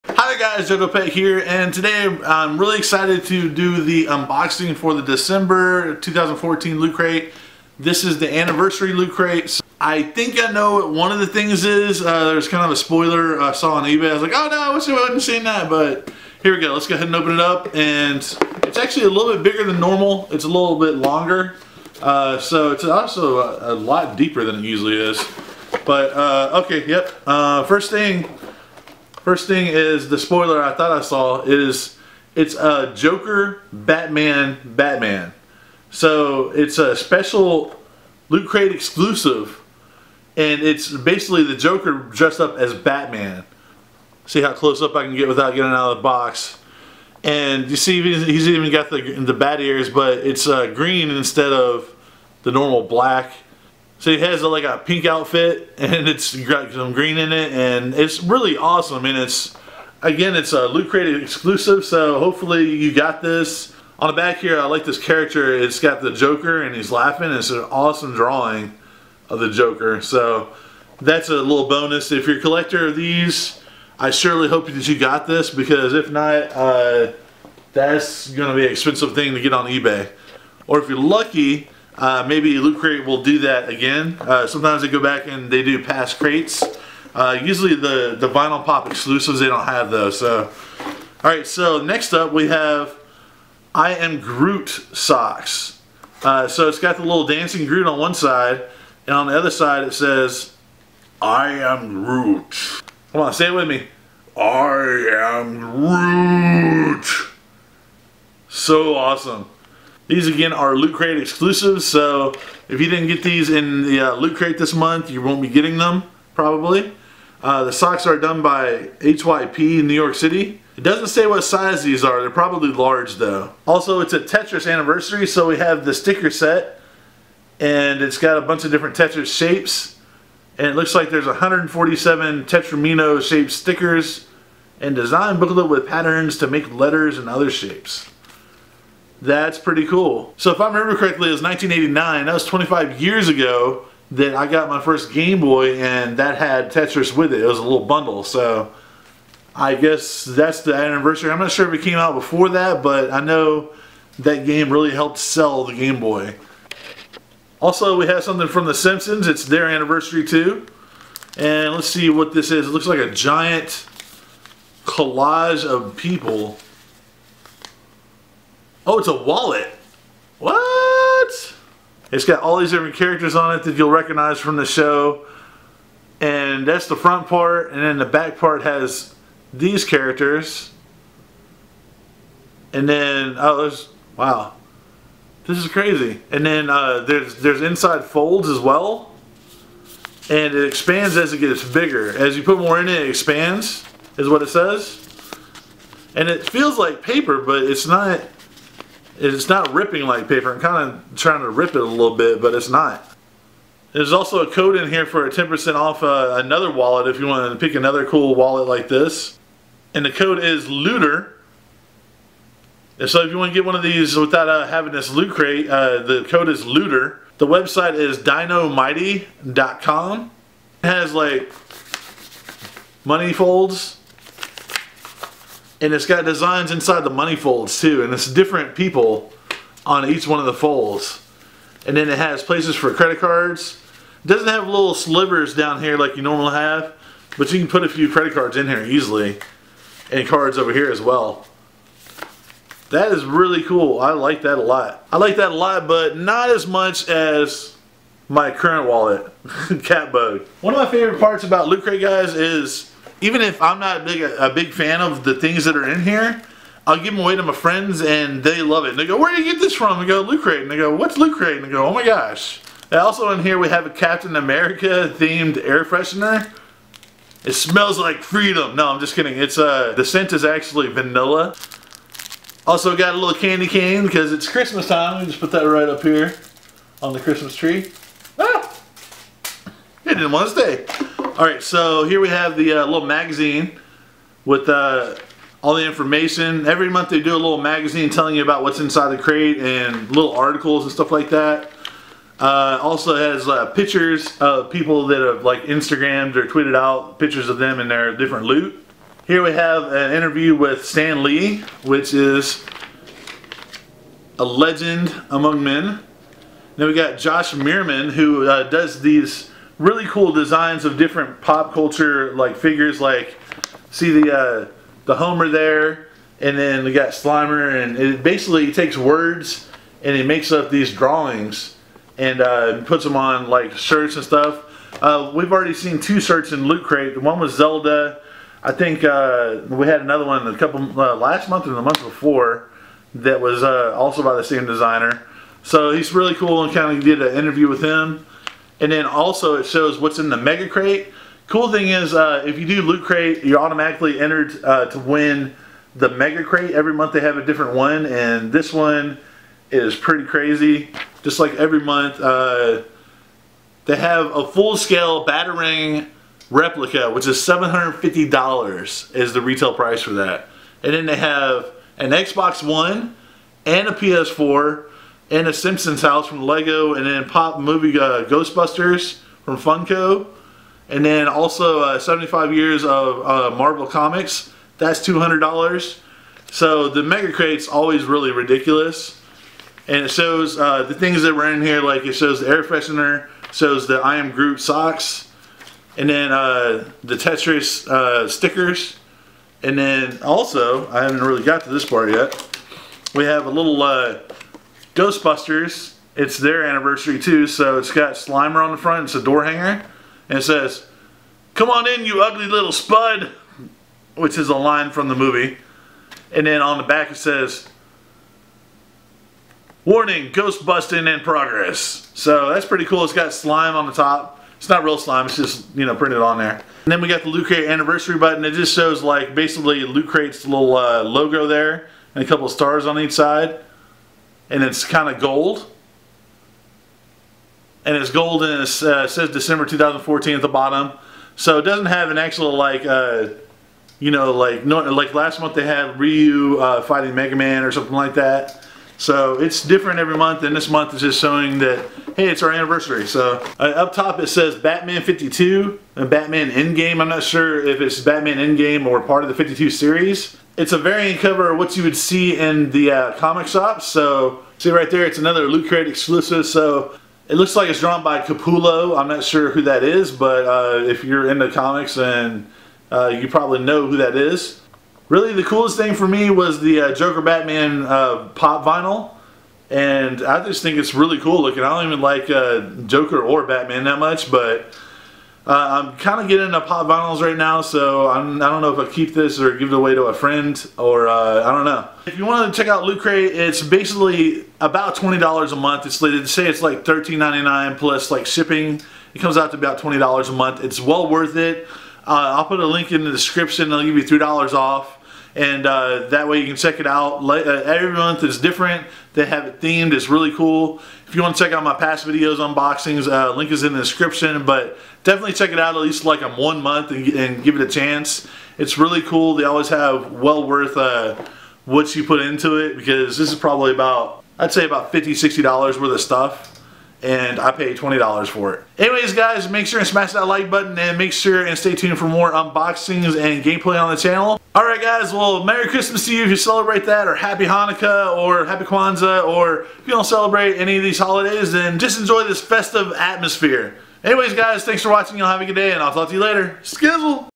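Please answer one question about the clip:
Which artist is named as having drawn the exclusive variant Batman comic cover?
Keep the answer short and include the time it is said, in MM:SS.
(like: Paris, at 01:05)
Capullo, at 07:38.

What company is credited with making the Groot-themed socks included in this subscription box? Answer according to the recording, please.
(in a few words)
HYP.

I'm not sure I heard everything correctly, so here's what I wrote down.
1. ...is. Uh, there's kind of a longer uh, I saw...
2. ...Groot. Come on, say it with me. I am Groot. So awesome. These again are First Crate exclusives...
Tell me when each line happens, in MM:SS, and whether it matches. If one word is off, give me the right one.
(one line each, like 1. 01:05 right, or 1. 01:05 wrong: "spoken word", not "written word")
1. 00:11 wrong: "spoiler", not "longer"
2. 01:42 wrong: "Loot", not "First".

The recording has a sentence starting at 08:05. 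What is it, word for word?
It's they say it's like $13.99 plus like shipping.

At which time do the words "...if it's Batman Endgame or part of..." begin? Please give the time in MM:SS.
07:27.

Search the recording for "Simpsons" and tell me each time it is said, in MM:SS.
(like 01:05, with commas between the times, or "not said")
02:38, 06:05.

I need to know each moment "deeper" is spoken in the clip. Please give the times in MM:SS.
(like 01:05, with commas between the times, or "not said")
00:24.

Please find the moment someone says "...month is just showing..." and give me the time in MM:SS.
07:20.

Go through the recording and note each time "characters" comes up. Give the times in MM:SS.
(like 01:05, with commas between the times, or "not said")
01:04, 02:52, 02:59.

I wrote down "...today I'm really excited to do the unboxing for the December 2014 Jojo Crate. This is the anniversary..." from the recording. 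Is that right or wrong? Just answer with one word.
wrong.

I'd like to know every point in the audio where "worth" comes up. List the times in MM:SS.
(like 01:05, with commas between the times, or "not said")
08:11, 08:30, 08:35.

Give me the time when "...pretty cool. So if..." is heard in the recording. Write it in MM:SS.
02:19.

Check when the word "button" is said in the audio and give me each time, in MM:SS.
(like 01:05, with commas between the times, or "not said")
06:58, 08:40.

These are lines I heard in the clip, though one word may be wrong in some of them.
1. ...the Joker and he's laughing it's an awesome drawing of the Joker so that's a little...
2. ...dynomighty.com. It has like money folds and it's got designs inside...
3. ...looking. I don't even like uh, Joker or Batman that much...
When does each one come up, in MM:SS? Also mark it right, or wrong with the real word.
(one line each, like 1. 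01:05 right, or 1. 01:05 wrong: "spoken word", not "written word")
1. 01:06 right
2. 03:38 right
3. 07:51 right.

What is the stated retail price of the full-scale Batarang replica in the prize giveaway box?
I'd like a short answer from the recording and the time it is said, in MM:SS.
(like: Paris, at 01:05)
$750, at 05:57.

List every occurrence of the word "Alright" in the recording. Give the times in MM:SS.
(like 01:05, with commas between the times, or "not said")
01:31, 08:44.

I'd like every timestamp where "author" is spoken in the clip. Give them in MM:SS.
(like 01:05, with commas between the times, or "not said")
not said.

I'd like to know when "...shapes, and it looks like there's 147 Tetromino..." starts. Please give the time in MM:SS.
02:09.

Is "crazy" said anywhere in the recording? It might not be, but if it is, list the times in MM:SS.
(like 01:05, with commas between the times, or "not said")
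03:05, 05:50.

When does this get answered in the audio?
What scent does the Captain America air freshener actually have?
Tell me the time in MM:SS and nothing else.
04:30.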